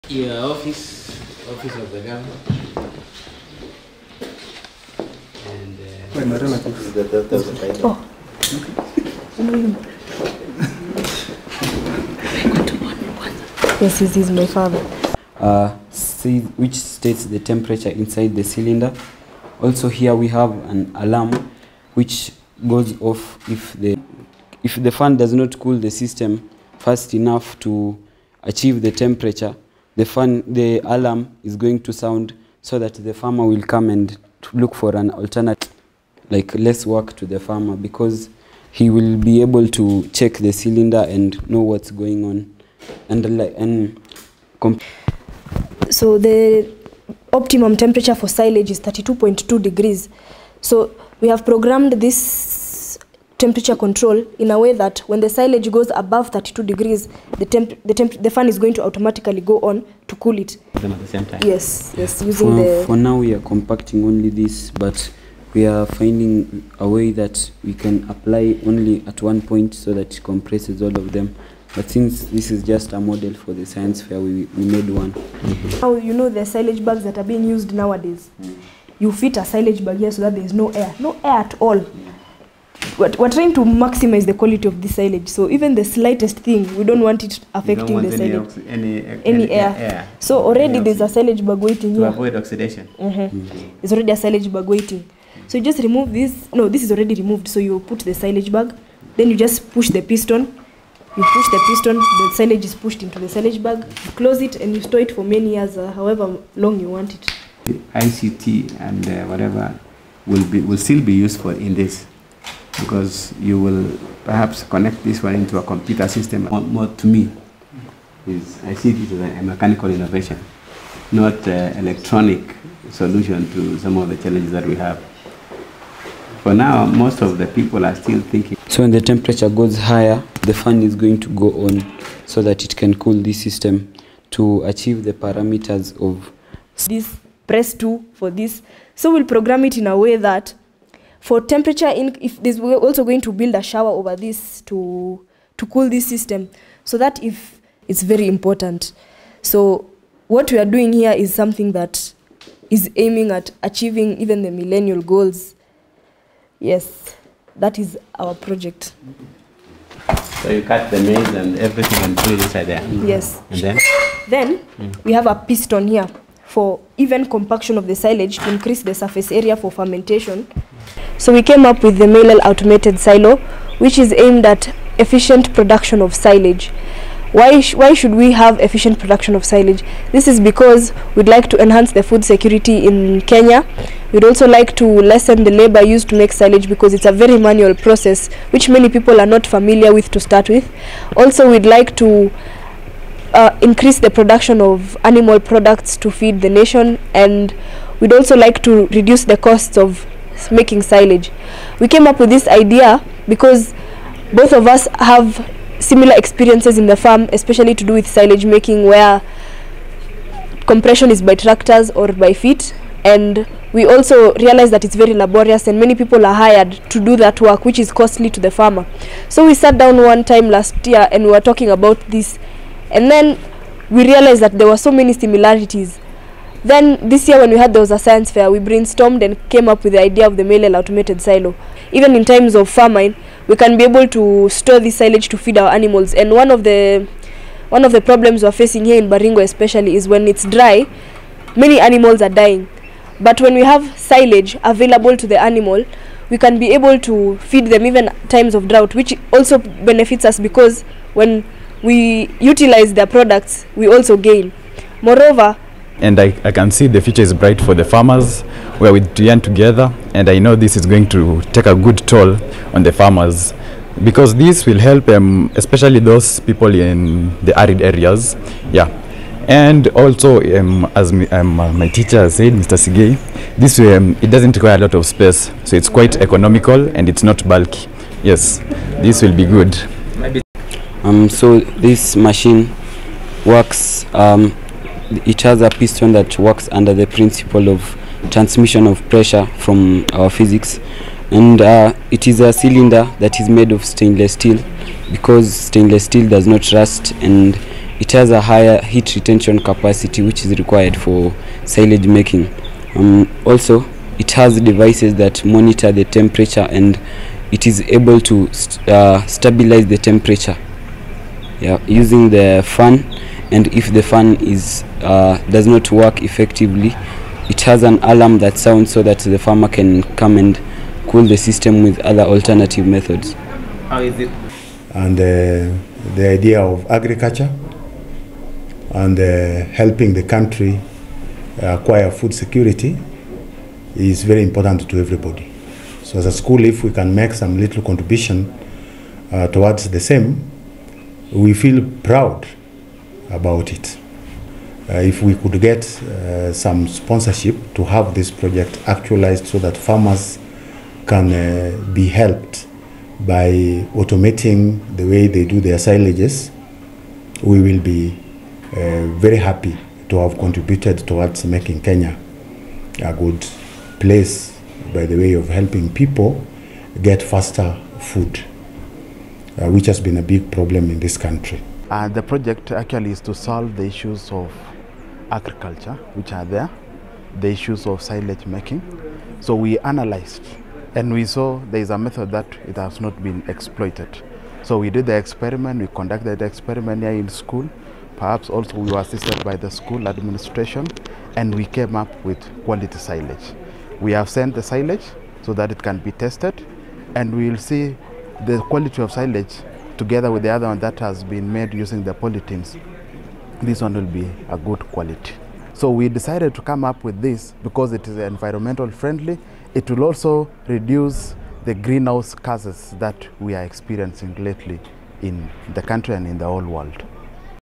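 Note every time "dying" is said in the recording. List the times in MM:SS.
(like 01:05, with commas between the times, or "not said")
04:02.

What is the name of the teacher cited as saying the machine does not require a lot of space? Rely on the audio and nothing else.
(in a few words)
Mr. Sigei.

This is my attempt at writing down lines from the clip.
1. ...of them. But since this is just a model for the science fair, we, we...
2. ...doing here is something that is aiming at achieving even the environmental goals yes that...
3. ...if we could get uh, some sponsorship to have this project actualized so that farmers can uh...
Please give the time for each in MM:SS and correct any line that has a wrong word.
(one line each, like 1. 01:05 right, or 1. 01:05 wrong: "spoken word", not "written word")
1. 01:10 right
2. 02:30 wrong: "millennial", not "environmental"
3. 05:44 right.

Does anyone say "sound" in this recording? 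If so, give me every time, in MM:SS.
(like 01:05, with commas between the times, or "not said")
00:31, 05:18.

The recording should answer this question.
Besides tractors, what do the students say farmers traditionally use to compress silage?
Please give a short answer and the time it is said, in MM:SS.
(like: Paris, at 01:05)
Feet, at 03:32.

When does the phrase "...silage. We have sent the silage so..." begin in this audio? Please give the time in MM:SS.
06:32.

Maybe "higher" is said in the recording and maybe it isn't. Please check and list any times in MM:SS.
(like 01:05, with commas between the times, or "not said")
02:09, 04:58.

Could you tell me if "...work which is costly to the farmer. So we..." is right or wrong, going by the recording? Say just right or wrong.
right.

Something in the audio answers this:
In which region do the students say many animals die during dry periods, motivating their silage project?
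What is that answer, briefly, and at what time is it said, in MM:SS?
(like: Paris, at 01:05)
Baringo, at 03:59.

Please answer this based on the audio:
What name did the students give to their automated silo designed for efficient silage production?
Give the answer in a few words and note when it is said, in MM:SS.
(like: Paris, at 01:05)
Malal automated silo, at 02:52.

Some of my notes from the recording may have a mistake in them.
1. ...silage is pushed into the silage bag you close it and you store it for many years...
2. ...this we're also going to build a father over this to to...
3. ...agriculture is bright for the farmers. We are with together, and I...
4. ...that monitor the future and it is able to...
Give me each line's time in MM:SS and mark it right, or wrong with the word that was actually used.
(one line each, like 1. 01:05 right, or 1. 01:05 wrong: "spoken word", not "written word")
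1. 01:42 right
2. 02:22 wrong: "shower", not "father"
3. 04:17 wrong: "future", not "agriculture"
4. 05:05 wrong: "temperature", not "future".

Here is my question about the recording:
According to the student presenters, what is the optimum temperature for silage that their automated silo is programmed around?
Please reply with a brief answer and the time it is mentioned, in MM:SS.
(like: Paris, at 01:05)
32.2 degrees, at 00:48.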